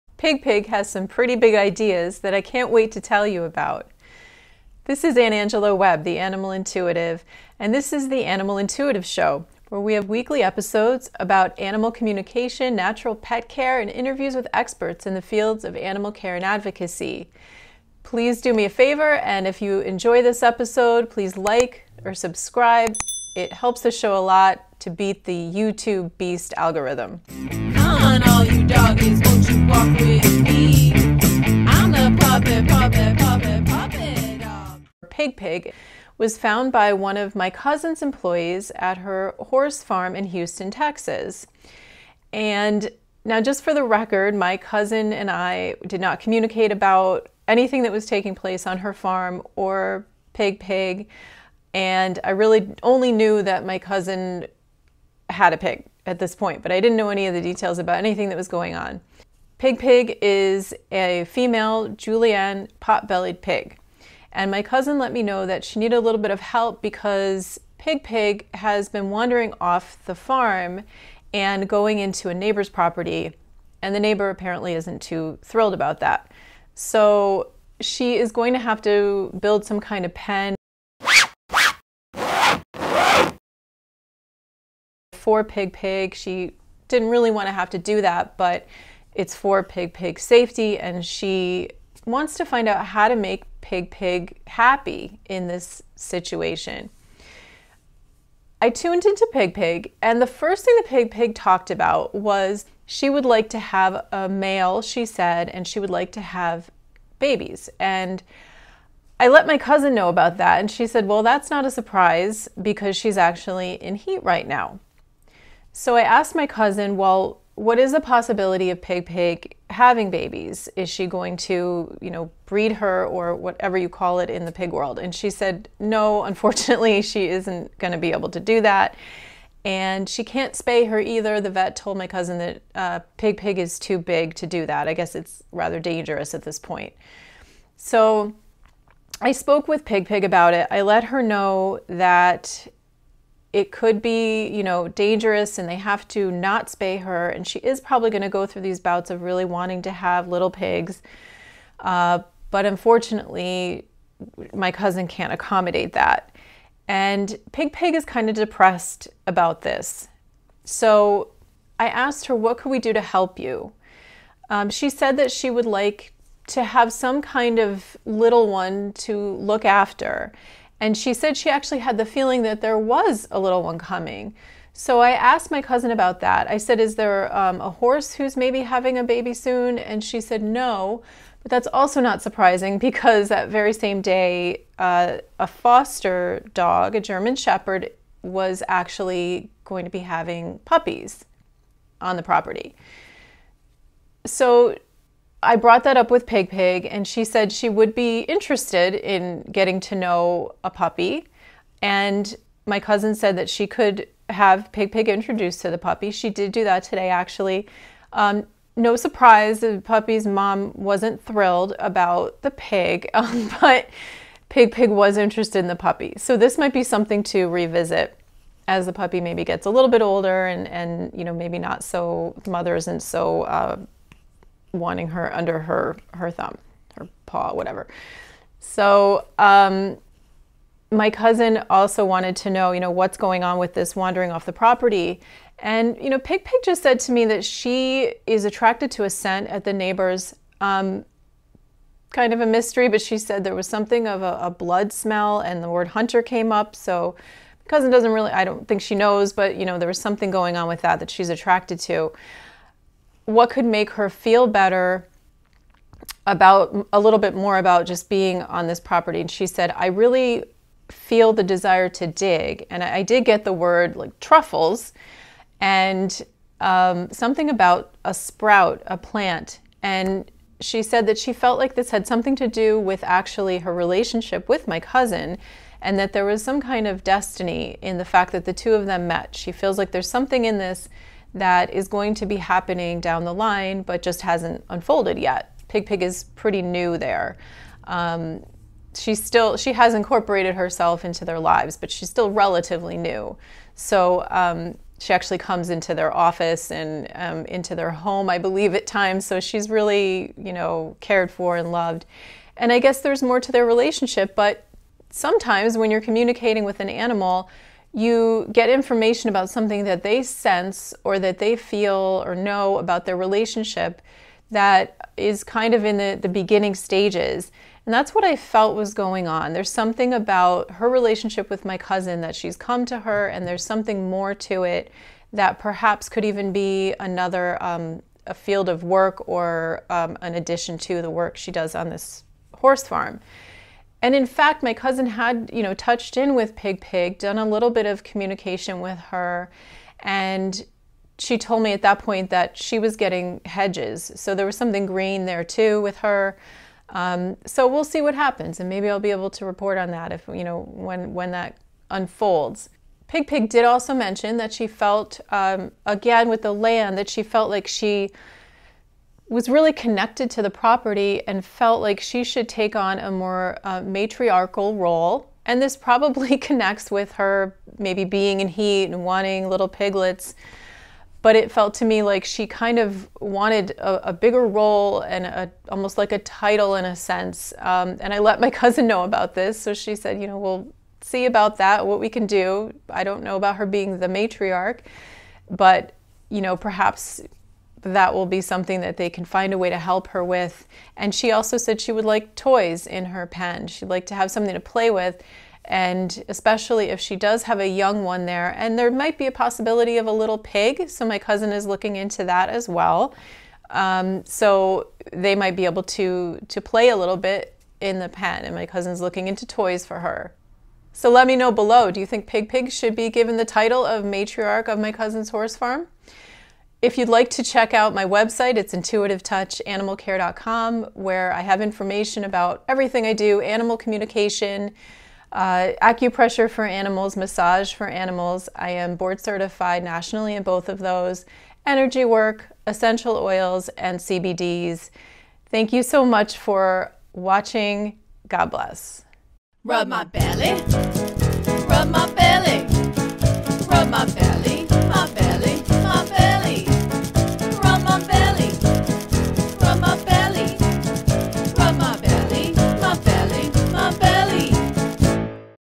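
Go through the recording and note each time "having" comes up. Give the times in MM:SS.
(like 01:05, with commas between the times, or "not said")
01:59, 02:58, 03:09.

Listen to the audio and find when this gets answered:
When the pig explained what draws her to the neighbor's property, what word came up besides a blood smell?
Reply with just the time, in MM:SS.
04:05.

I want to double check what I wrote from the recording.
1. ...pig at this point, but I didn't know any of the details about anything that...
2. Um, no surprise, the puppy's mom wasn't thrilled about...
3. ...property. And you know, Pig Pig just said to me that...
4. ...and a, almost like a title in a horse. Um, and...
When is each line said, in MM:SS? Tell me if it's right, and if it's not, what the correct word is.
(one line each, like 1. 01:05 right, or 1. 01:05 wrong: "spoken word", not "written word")
1. 00:55 right
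2. 03:28 right
3. 03:54 right
4. 06:15 wrong: "sense", not "horse".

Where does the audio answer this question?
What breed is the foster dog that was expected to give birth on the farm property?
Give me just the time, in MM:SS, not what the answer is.
03:07.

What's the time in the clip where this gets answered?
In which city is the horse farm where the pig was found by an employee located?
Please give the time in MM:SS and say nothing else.
00:40.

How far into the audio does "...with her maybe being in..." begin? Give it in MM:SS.
06:06.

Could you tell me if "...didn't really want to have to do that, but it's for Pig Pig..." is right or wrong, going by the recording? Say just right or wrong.
right.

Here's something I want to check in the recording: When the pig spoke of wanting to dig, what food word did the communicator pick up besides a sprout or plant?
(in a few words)
truffles.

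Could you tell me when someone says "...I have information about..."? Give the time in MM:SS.
07:01.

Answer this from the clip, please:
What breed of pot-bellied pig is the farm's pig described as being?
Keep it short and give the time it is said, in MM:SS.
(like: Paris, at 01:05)
Juliana, at 01:01.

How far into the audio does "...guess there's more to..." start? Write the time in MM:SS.
05:02.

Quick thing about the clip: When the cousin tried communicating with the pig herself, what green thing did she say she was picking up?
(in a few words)
hedges.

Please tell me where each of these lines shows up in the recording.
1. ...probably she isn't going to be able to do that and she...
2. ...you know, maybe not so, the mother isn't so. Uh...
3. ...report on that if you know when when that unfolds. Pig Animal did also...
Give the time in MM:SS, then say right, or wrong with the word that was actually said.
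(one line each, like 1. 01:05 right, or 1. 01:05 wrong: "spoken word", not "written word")
1. 02:06 wrong: "unfortunately", not "probably"
2. 03:41 right
3. 05:49 wrong: "Pig", not "Animal".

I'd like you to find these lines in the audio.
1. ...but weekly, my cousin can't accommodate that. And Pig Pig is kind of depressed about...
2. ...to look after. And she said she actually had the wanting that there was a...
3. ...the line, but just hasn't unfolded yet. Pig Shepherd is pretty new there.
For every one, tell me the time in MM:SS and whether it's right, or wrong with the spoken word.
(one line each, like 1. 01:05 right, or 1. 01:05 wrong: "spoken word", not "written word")
1. 02:32 wrong: "unfortunately", not "weekly"
2. 02:48 wrong: "feeling", not "wanting"
3. 04:43 wrong: "Pig", not "Shepherd".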